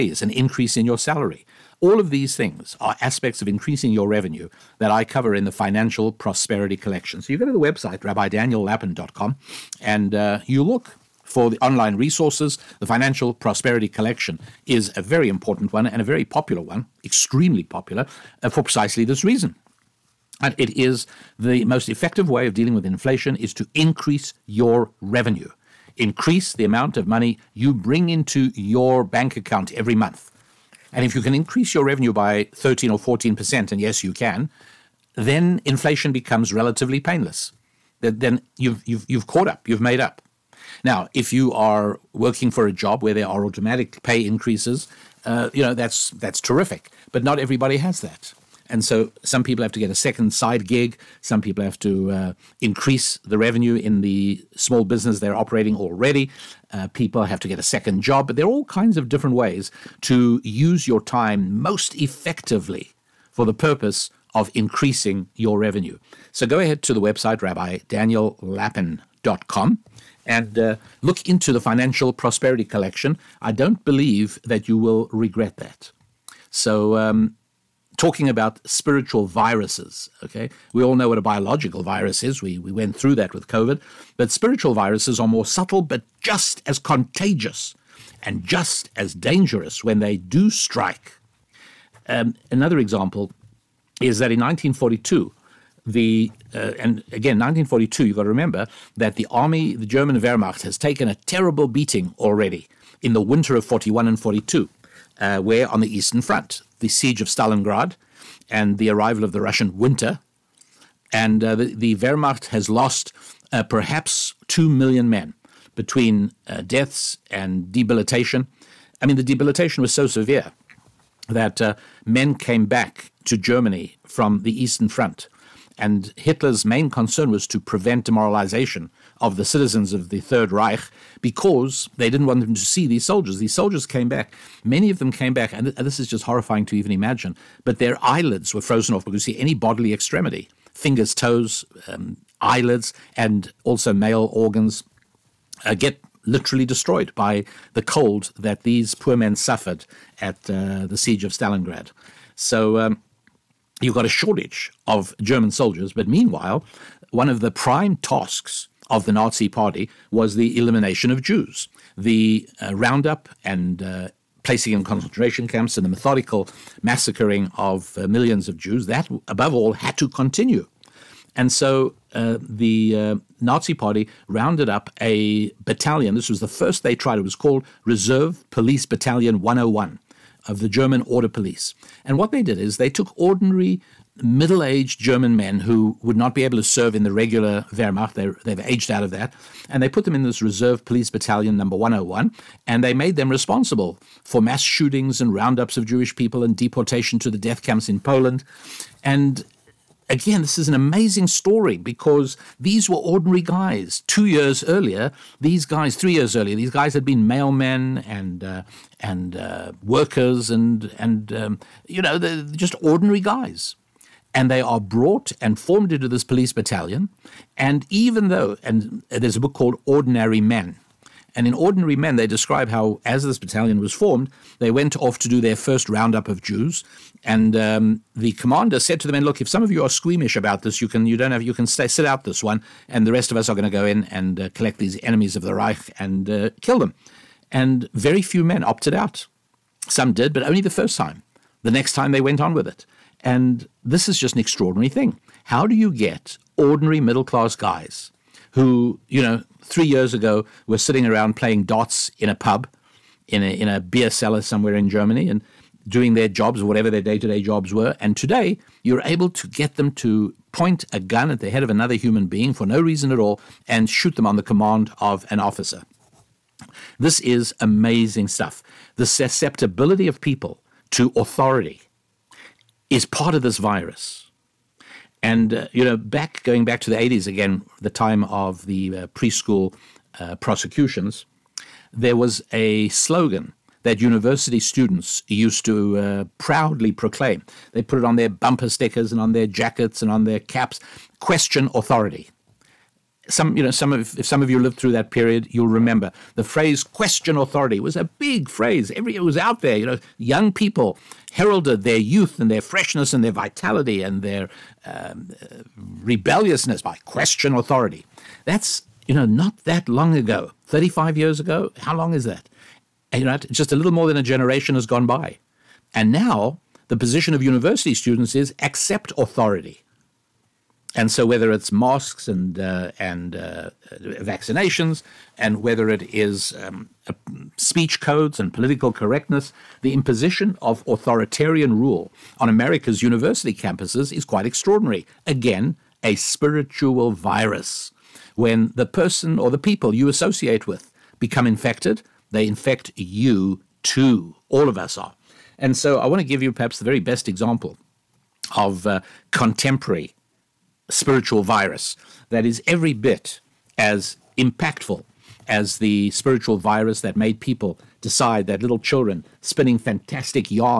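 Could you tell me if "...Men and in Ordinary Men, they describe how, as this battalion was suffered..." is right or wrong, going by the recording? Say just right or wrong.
wrong.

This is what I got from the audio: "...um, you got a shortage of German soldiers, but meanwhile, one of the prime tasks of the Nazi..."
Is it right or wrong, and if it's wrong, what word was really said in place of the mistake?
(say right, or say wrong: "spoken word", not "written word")
right.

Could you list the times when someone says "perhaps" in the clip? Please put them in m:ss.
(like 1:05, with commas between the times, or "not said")
1:53, 5:46.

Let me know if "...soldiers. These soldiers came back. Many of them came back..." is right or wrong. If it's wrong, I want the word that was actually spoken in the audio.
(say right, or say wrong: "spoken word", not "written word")
right.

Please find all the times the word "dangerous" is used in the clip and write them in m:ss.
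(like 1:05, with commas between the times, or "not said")
1:29.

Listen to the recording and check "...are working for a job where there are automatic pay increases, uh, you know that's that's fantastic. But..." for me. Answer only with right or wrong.
wrong.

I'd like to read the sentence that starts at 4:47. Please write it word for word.
They put it on their bumper stickers and on their jackets and on their caps question authority.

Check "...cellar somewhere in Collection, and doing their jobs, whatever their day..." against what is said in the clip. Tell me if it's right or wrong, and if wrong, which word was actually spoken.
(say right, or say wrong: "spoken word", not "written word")
wrong: "Germany", not "Collection".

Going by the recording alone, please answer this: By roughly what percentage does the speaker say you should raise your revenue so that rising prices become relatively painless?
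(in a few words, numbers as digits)
13 or 14%.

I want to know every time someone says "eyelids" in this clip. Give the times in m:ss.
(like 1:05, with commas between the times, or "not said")
2:18, 2:22.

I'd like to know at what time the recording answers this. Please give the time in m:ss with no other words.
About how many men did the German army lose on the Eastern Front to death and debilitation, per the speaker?
1:54.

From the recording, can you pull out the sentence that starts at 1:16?
So, um, talking about spiritual viruses.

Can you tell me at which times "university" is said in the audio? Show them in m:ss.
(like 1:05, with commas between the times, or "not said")
4:44, 5:17, 5:33.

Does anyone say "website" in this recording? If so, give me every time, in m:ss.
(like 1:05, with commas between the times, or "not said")
0:07, 1:07.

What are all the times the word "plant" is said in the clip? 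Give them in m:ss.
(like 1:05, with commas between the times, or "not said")
not said.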